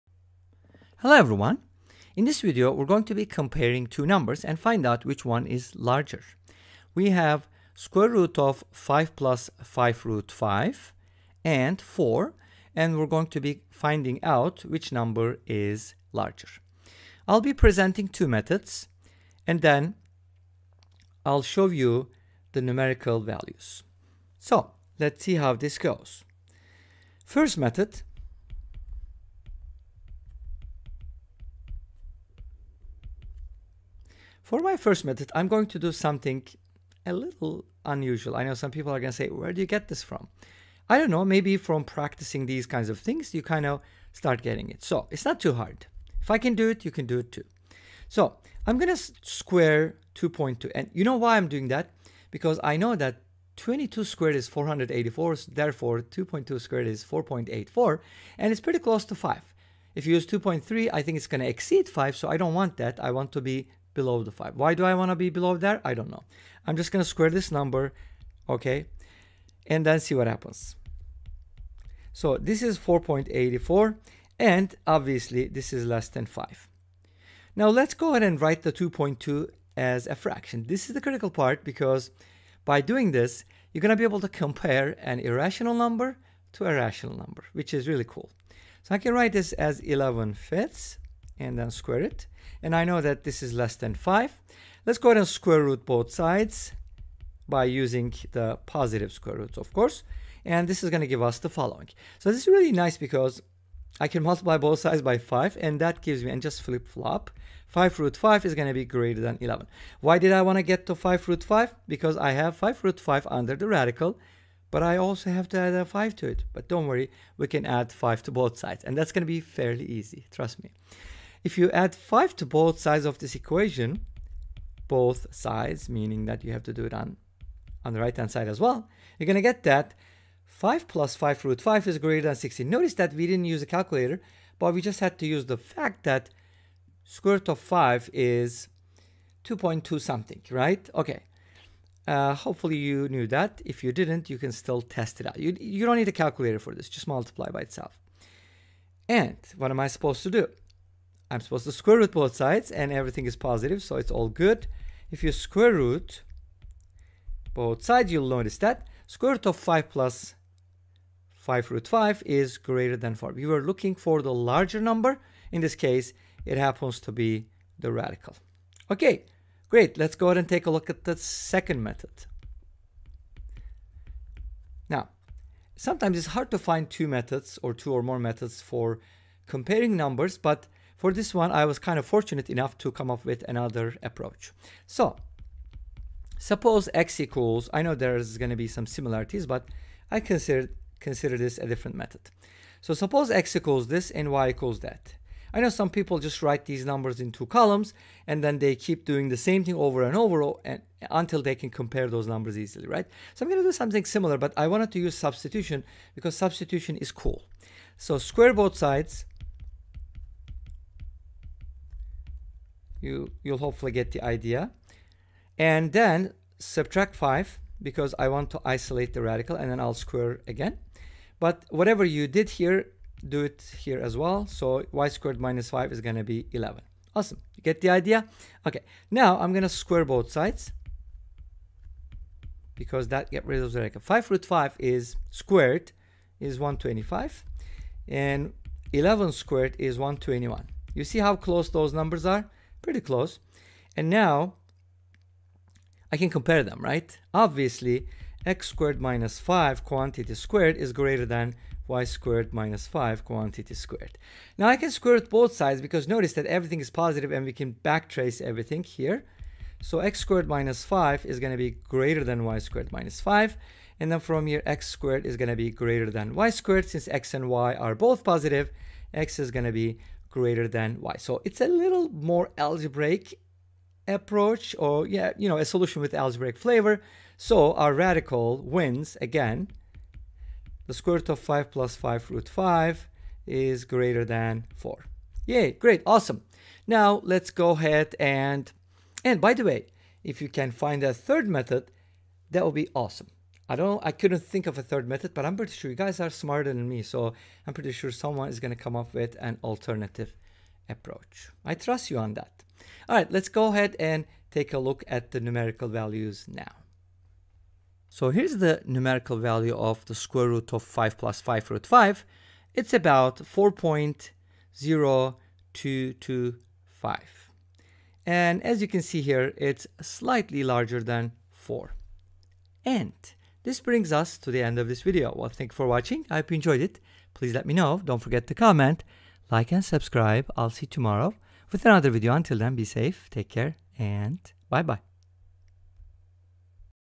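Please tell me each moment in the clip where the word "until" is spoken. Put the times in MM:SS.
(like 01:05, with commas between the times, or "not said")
03:21, 05:32.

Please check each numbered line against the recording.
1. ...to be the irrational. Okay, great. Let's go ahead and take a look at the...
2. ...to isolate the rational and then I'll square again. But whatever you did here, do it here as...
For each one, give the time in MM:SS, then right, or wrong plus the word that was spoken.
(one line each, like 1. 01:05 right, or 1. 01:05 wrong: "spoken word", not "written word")
1. 02:46 wrong: "radical", not "irrational"
2. 03:38 wrong: "radical", not "rational".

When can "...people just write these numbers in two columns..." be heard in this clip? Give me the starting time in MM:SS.
03:15.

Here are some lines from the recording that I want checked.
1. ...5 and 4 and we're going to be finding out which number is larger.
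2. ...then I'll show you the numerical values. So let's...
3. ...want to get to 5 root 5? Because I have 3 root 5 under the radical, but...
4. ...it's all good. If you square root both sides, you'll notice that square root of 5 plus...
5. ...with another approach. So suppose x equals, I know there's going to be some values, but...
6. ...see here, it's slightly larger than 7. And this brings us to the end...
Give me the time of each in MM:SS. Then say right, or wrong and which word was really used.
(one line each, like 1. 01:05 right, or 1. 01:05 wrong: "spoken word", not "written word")
1. 00:10 right
2. 00:19 right
3. 01:50 wrong: "5", not "3"
4. 02:33 right
5. 03:03 wrong: "similarities", not "values"
6. 05:19 wrong: "4", not "7".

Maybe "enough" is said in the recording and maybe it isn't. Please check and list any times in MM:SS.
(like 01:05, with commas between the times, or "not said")
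03:02.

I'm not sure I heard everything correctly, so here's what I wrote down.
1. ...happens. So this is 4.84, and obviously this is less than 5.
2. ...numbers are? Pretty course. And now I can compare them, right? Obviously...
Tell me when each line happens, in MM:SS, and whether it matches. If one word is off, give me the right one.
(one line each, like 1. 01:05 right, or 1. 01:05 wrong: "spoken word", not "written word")
1. 01:10 right
2. 04:01 wrong: "close", not "course".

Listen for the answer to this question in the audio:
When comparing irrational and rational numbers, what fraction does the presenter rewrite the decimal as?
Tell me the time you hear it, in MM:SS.
01:29.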